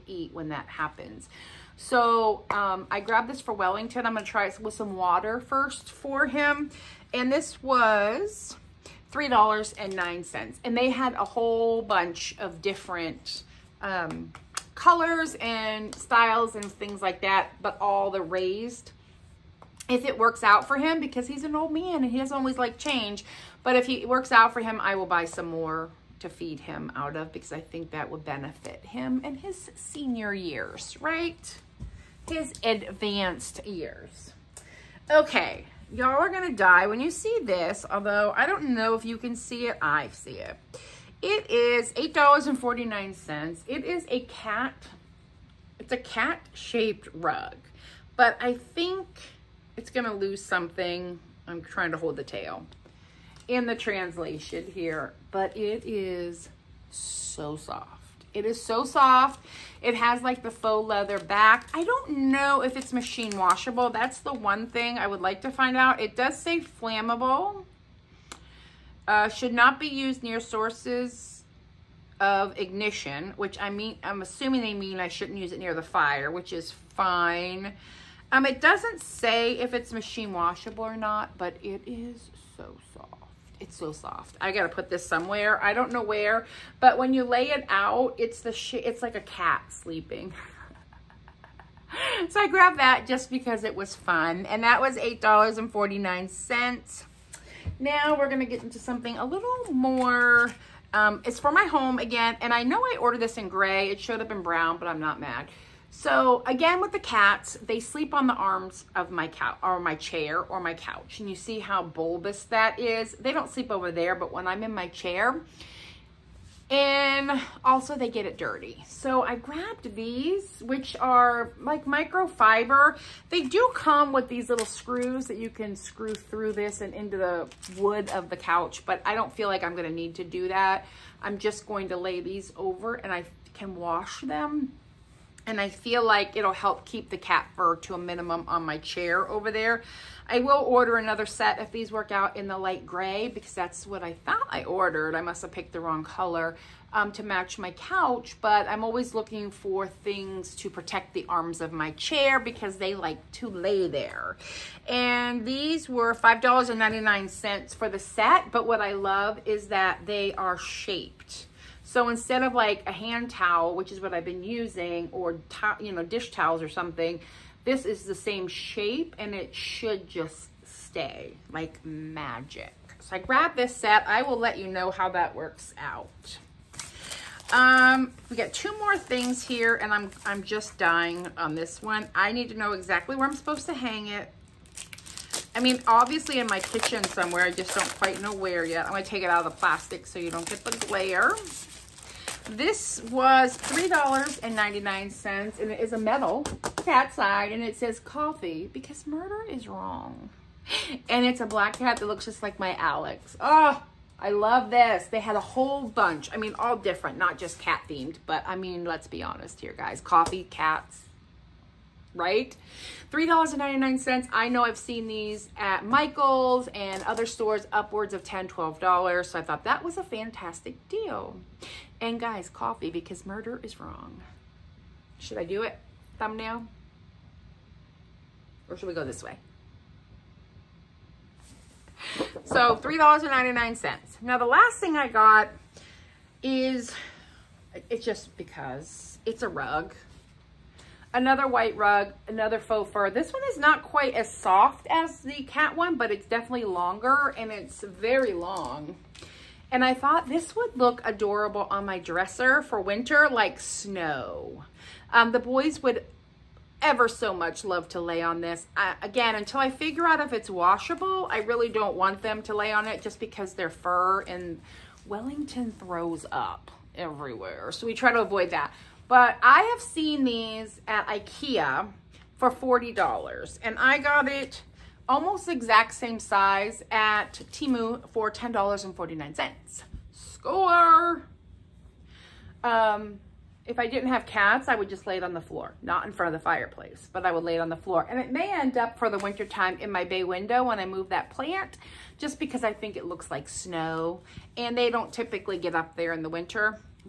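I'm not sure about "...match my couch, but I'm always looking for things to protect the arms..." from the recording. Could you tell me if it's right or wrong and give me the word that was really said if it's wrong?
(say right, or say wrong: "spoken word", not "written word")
right.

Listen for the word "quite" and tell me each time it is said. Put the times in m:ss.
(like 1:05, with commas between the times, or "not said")
3:07, 4:03.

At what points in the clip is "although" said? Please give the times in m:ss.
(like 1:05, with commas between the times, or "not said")
0:37.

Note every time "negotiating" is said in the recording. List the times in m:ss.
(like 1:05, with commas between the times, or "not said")
not said.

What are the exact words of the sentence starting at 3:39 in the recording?
So I thought that was a fantastic deal.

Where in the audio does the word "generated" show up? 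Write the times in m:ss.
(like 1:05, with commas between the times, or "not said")
not said.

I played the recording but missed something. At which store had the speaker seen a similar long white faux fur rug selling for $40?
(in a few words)
Ikea.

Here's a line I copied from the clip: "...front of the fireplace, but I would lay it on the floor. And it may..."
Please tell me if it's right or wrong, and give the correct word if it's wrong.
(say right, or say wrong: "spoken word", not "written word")
right.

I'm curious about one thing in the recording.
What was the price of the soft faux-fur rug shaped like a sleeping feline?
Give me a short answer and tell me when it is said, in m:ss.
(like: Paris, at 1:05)
$8.49, at 0:41.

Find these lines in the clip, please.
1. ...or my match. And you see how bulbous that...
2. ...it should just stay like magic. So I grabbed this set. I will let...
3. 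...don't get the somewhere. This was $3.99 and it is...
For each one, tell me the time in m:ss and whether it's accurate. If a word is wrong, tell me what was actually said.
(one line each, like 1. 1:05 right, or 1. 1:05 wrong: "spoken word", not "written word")
1. 1:50 wrong: "couch", not "match"
2. 2:49 right
3. 3:10 wrong: "glare", not "somewhere".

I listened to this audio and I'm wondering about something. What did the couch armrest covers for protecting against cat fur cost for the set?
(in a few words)
$5.99.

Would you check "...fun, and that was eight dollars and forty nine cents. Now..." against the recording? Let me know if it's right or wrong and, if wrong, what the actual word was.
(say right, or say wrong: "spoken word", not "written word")
right.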